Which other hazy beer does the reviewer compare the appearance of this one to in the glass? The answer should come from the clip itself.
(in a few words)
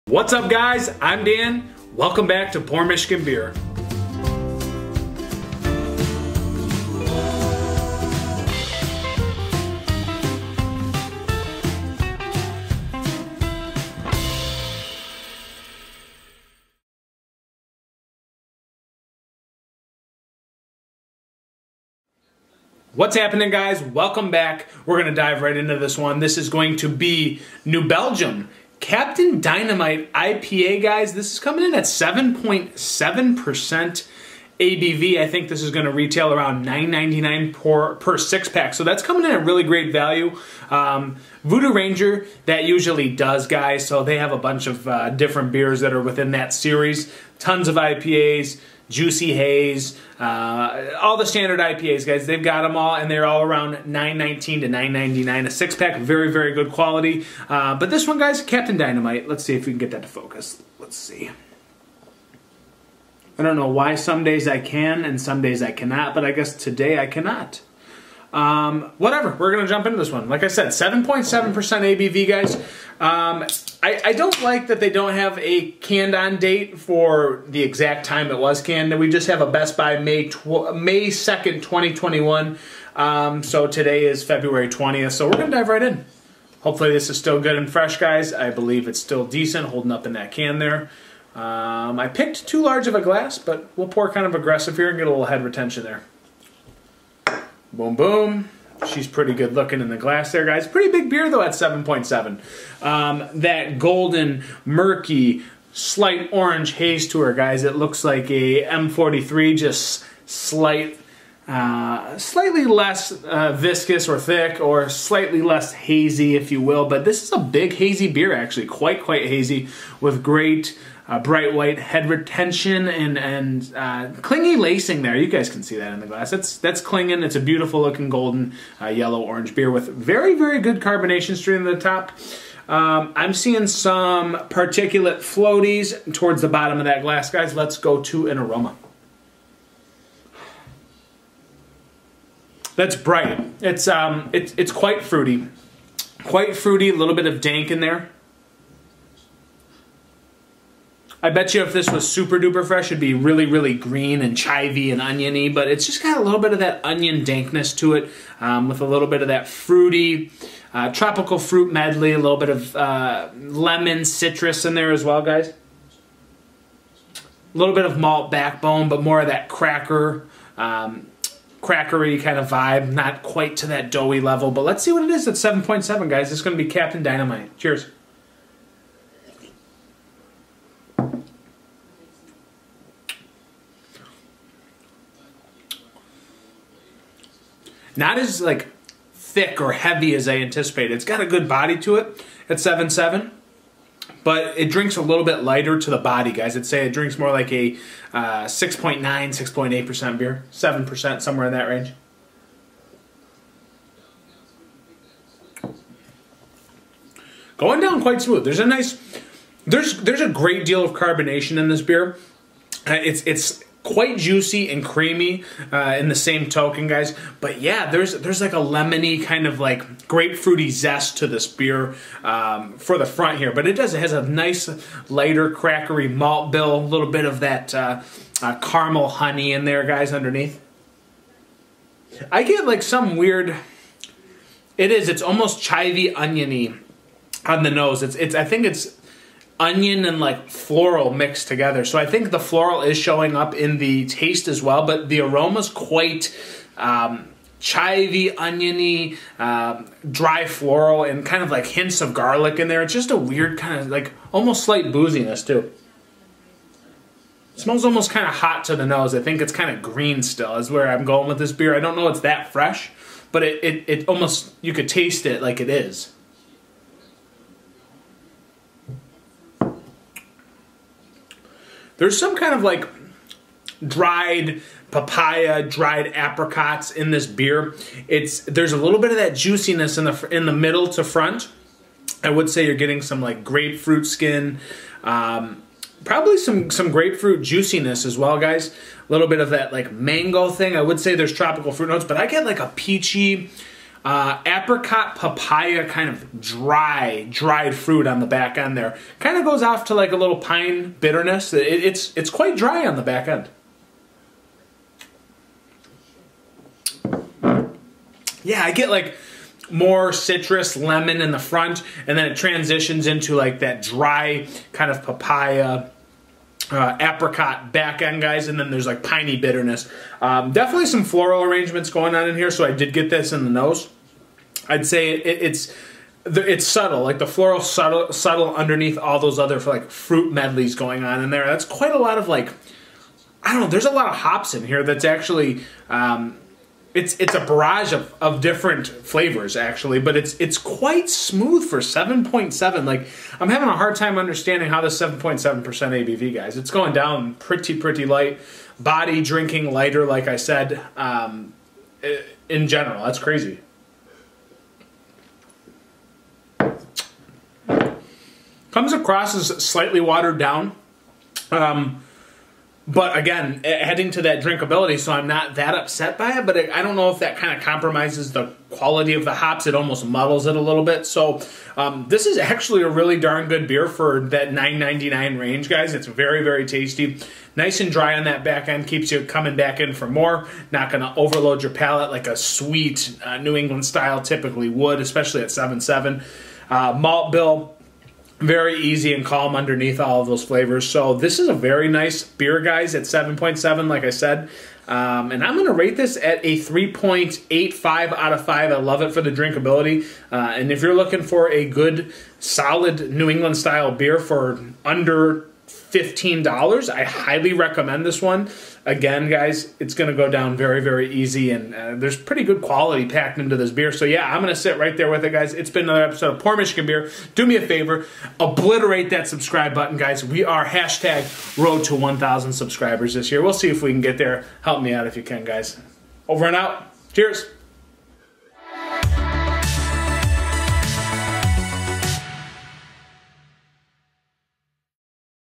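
M43.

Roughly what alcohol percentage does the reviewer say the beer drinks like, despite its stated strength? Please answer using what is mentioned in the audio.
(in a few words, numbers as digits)
6.9%.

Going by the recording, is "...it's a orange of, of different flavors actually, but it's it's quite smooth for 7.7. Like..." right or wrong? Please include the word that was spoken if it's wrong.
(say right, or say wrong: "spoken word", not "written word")
wrong: "barrage", not "orange".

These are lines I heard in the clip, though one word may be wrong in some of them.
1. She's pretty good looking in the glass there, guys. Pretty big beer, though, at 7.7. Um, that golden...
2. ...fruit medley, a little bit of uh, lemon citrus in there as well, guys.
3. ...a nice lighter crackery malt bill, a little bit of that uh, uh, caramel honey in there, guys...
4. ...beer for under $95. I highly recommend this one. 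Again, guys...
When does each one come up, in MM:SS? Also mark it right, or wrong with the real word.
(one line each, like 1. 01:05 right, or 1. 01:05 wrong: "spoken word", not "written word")
1. 01:38 right
2. 02:41 right
3. 03:44 right
4. 06:43 wrong: "15", not "95".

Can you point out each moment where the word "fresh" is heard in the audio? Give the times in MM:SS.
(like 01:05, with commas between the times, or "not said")
01:27, 02:32, 04:22.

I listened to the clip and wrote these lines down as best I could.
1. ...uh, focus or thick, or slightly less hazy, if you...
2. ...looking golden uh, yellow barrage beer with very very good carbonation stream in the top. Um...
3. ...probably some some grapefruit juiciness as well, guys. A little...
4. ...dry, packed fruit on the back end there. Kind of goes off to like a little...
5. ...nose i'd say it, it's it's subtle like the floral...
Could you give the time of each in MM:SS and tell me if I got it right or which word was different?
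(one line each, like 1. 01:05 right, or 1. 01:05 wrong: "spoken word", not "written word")
1. 01:53 wrong: "viscous", not "focus"
2. 02:07 wrong: "orange", not "barrage"
3. 04:46 right
4. 04:56 wrong: "dried", not "packed"
5. 05:23 right.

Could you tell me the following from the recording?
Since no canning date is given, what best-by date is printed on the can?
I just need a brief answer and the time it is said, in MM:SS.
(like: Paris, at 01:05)
May 2nd, 2021, at 01:20.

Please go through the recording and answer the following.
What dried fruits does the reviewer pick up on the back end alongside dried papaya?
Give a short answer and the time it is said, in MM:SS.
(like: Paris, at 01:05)
Dried apricots, at 04:35.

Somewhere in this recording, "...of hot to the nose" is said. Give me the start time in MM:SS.
04:18.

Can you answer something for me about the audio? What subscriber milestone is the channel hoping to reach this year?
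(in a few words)
1,000 subscribers.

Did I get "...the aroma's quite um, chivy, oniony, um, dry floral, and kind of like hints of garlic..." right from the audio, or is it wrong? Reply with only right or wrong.
right.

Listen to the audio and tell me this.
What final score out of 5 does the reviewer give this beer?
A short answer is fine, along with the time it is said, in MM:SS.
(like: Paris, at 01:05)
3.85, at 06:36.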